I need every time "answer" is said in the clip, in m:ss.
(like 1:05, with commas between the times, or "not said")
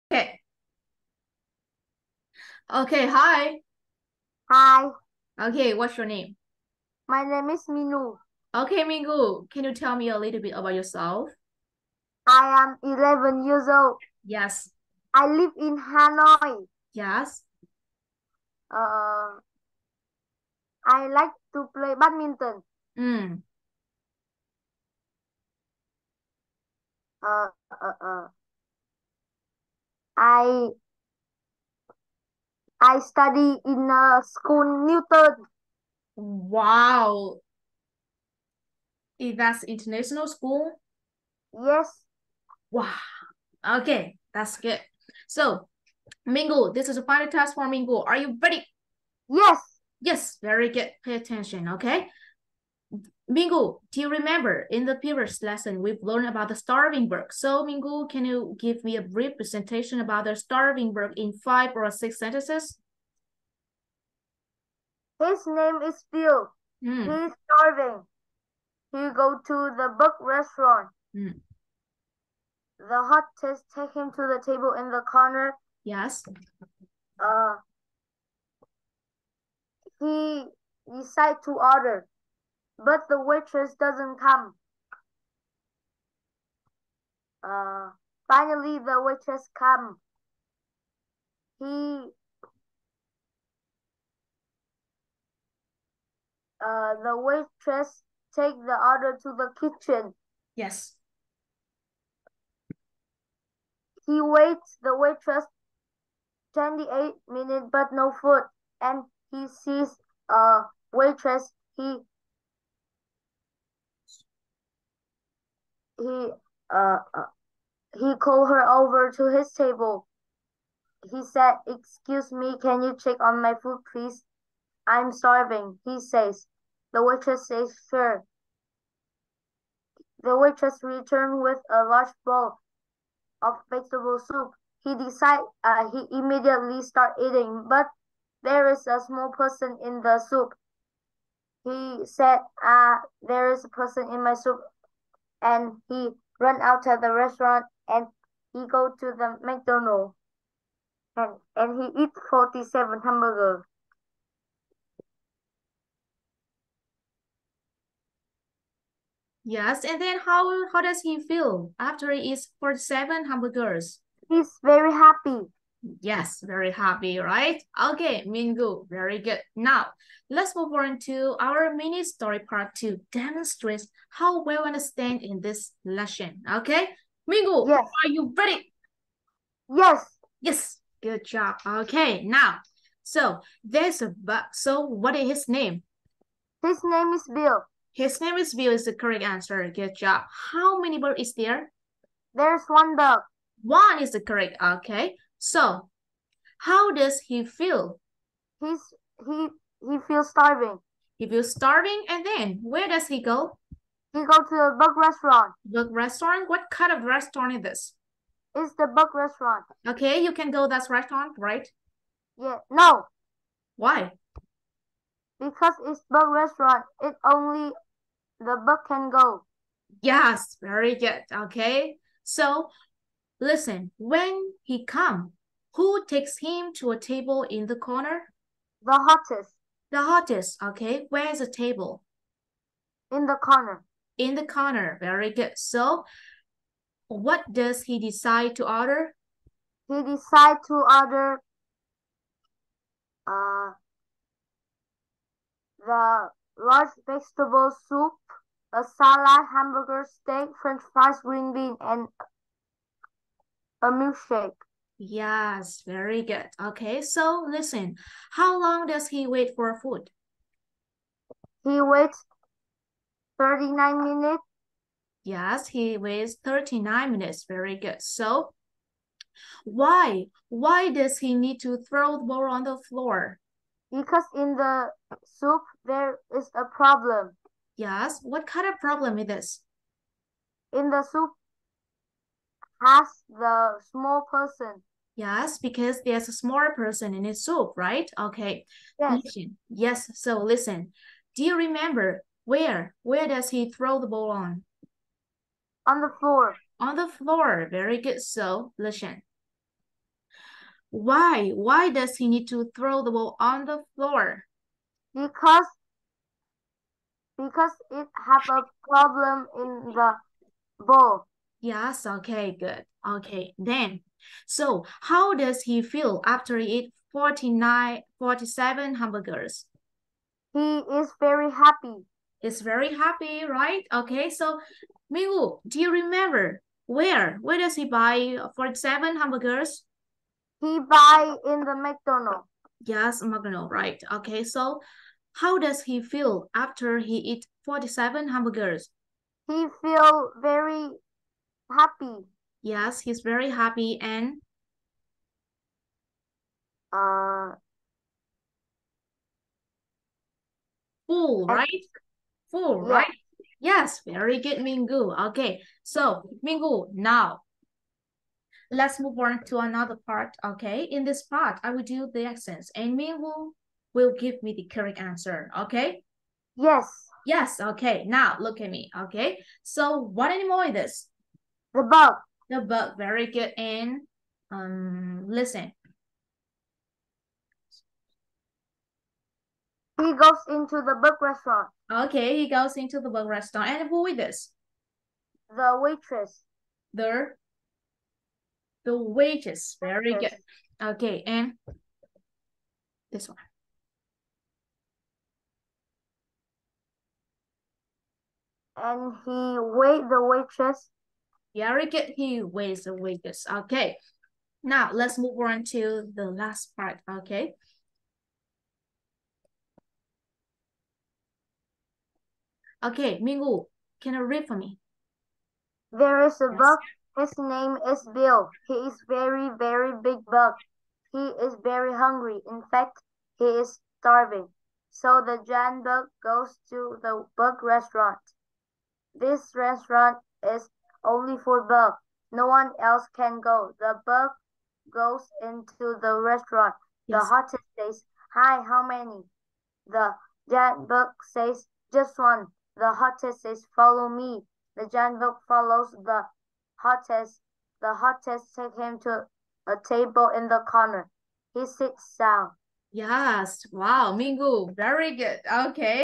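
3:09, 6:04.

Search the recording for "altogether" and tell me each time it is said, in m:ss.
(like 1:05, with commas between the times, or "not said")
not said.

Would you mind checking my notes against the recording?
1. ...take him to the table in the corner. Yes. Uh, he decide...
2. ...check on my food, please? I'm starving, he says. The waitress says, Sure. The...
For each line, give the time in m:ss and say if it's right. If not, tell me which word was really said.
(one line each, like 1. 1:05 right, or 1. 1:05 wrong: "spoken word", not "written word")
1. 1:13 right
2. 2:03 right.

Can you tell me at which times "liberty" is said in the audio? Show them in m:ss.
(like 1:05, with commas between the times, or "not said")
not said.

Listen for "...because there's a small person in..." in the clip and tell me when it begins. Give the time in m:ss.
4:45.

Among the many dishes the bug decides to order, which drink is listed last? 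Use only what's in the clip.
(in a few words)
Milkshake.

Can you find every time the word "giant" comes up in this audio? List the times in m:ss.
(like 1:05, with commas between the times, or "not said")
7:05, 7:20, 7:24.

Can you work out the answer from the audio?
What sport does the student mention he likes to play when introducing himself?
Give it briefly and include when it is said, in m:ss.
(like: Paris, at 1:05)
Badminton, at 0:21.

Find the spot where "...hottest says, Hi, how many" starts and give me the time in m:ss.
7:17.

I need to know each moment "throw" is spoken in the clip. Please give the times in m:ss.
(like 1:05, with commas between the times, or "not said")
4:31, 4:53, 5:02.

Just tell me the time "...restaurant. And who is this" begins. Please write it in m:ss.
6:23.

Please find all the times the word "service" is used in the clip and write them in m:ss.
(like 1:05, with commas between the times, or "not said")
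not said.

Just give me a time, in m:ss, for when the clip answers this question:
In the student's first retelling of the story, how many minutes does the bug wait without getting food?
1:46.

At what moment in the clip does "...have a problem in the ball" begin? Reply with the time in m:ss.
5:08.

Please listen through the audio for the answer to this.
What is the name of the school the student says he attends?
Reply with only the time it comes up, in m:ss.
0:34.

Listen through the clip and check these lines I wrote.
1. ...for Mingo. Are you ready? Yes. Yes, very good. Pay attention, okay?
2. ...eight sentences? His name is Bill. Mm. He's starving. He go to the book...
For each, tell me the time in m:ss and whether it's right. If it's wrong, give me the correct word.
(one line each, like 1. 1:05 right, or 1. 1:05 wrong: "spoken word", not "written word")
1. 0:47 right
2. 1:01 wrong: "six", not "eight".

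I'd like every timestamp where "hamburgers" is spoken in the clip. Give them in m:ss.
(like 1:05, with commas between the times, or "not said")
2:33, 2:43, 4:09, 5:18, 5:29, 5:38.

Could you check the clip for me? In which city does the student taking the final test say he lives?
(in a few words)
Hanoi.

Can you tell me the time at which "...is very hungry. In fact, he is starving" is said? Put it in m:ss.
7:01.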